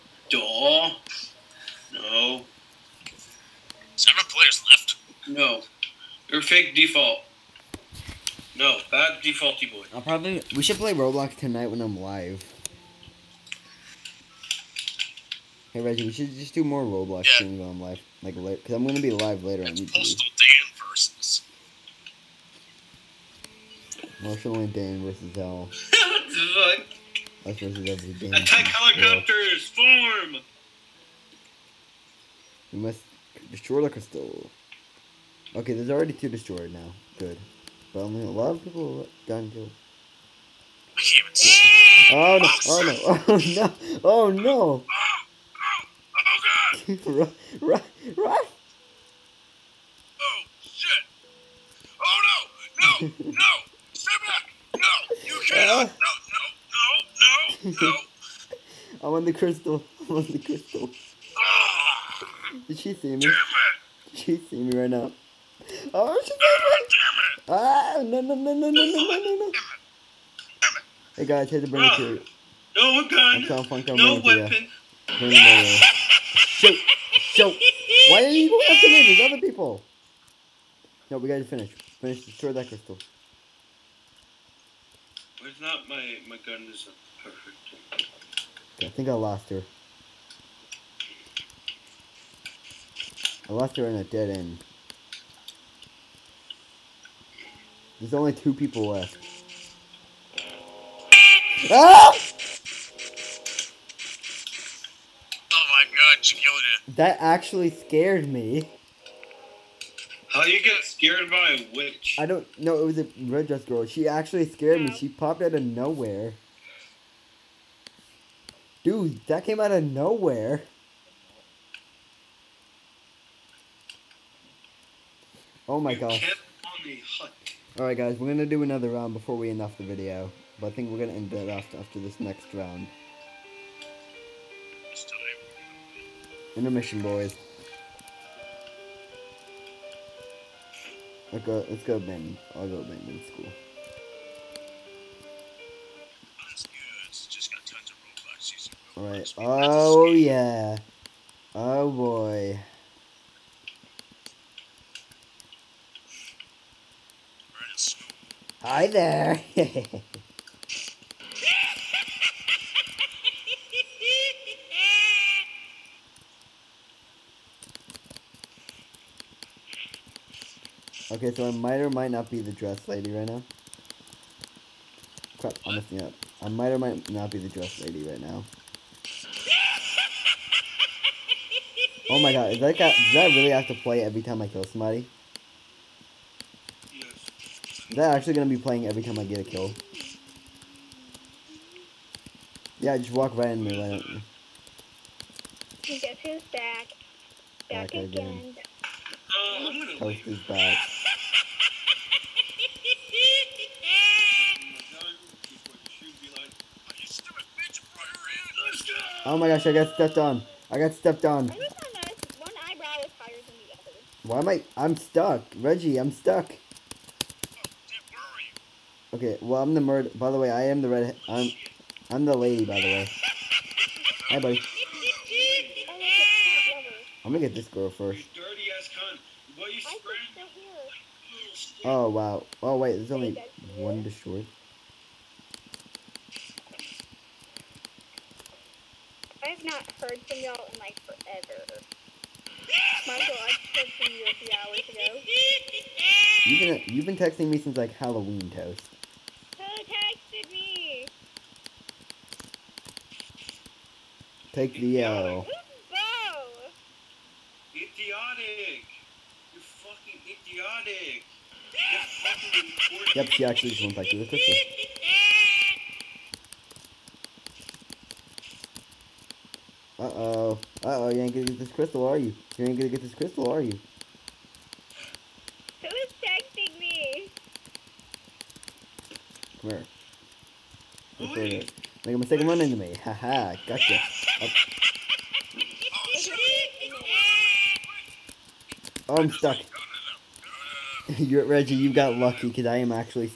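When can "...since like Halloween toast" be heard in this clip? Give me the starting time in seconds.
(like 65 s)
247 s.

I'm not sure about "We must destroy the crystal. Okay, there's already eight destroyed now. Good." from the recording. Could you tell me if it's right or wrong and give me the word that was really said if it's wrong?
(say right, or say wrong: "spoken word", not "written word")
wrong: "two", not "eight".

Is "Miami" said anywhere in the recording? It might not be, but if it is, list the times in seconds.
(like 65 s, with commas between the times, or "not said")
not said.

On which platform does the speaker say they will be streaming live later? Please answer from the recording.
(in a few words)
YouTube.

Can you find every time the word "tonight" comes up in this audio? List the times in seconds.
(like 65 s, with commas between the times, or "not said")
11 s.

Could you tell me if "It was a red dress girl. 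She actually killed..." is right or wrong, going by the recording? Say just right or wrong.
wrong.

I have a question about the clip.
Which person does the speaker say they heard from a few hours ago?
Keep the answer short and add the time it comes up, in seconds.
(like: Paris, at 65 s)
Michael, at 243 s.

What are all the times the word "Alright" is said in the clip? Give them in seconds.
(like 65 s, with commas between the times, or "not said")
127 s, 149 s.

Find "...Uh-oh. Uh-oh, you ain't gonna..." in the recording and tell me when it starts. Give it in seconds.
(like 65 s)
269 s.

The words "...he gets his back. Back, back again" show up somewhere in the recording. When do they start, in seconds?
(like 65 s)
195 s.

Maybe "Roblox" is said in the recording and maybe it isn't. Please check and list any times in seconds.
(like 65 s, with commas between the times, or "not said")
10 s, 16 s.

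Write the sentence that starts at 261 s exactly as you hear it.
You're fucking yep, she actually just went back to the crystal.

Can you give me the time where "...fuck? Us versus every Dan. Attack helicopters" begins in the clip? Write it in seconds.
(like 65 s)
26 s.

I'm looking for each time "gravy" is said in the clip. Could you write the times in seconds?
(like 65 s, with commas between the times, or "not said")
not said.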